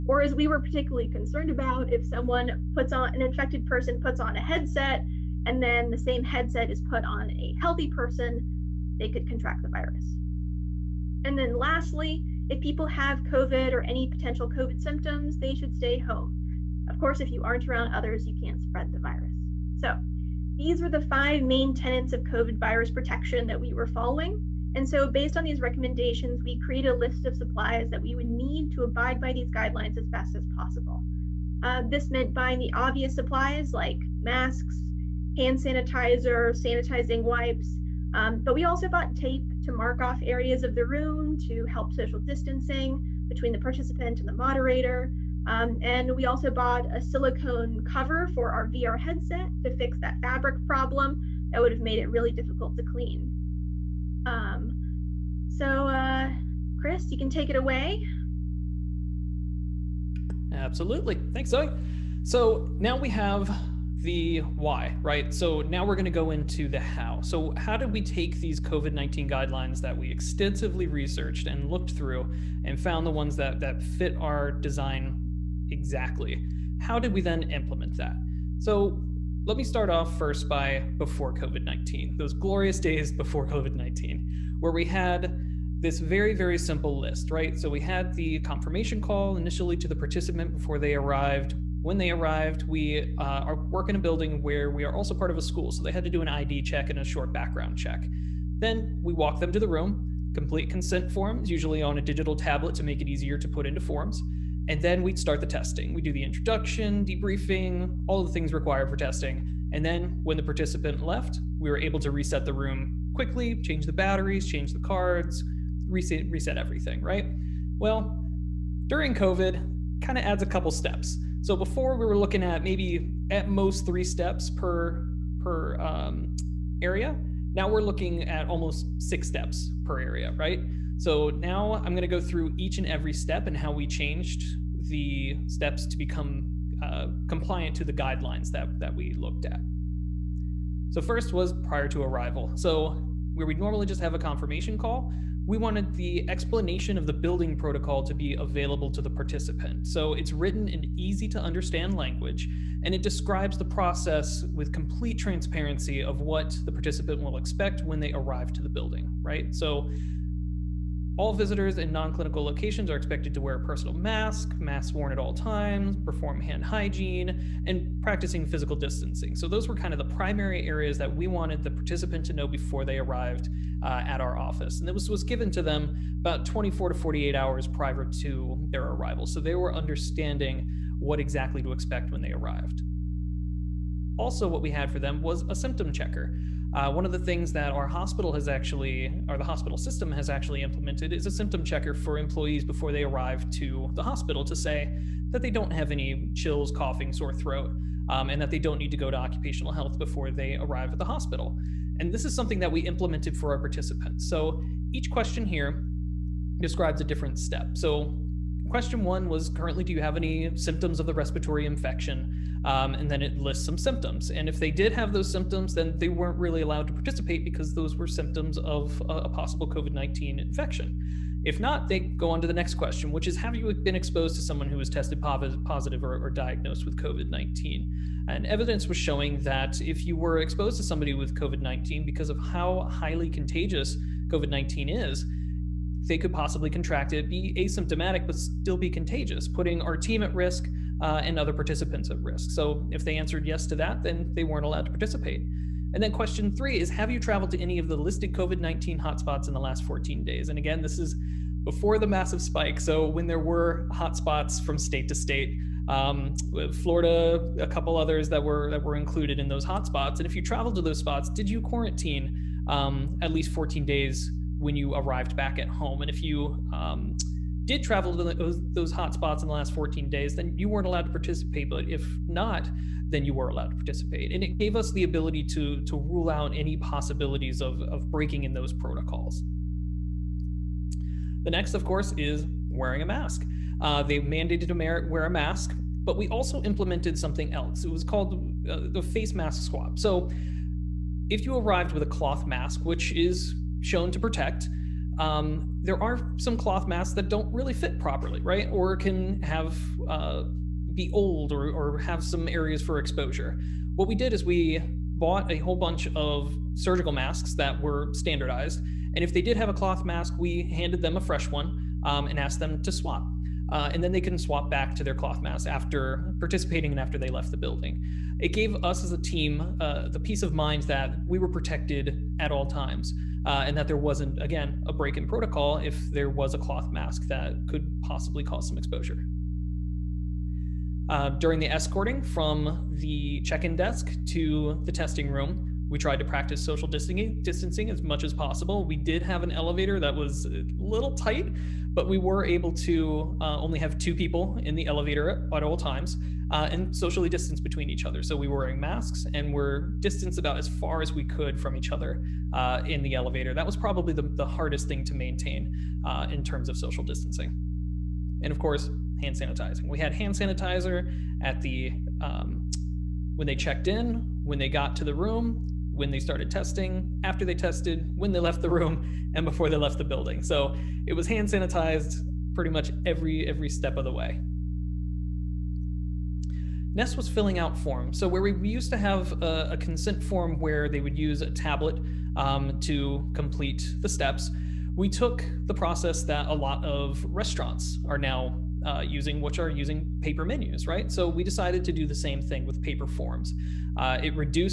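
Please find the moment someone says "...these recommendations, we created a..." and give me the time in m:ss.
0:25.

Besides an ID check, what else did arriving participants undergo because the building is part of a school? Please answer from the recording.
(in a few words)
short background check.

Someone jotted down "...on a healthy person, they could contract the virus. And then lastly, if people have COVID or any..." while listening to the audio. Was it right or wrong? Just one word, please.
right.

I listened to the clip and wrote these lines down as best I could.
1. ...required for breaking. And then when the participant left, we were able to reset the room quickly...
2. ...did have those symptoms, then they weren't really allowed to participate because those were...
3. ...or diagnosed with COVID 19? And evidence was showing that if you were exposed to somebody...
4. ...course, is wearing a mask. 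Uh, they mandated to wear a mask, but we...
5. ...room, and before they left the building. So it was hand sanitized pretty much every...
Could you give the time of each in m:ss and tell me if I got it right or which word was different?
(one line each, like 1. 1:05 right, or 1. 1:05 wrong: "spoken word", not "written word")
1. 1:48 wrong: "testing", not "breaking"
2. 3:34 right
3. 3:46 right
4. 4:41 right
5. 6:08 right.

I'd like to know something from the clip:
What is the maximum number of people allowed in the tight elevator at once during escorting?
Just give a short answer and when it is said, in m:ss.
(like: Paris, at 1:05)
2, at 5:43.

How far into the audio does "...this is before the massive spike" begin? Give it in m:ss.
4:10.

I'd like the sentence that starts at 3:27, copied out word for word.
So question one was currently, do you have any symptoms of the respiratory infection?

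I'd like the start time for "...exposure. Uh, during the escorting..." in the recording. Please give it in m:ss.
5:28.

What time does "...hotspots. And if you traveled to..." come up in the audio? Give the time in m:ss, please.
4:19.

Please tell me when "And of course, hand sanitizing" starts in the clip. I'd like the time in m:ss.
5:58.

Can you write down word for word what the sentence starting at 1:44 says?
And then we'd start the testing.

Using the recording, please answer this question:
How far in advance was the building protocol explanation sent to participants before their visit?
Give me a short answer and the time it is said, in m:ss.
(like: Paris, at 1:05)
24 to 48 hours, at 2:56.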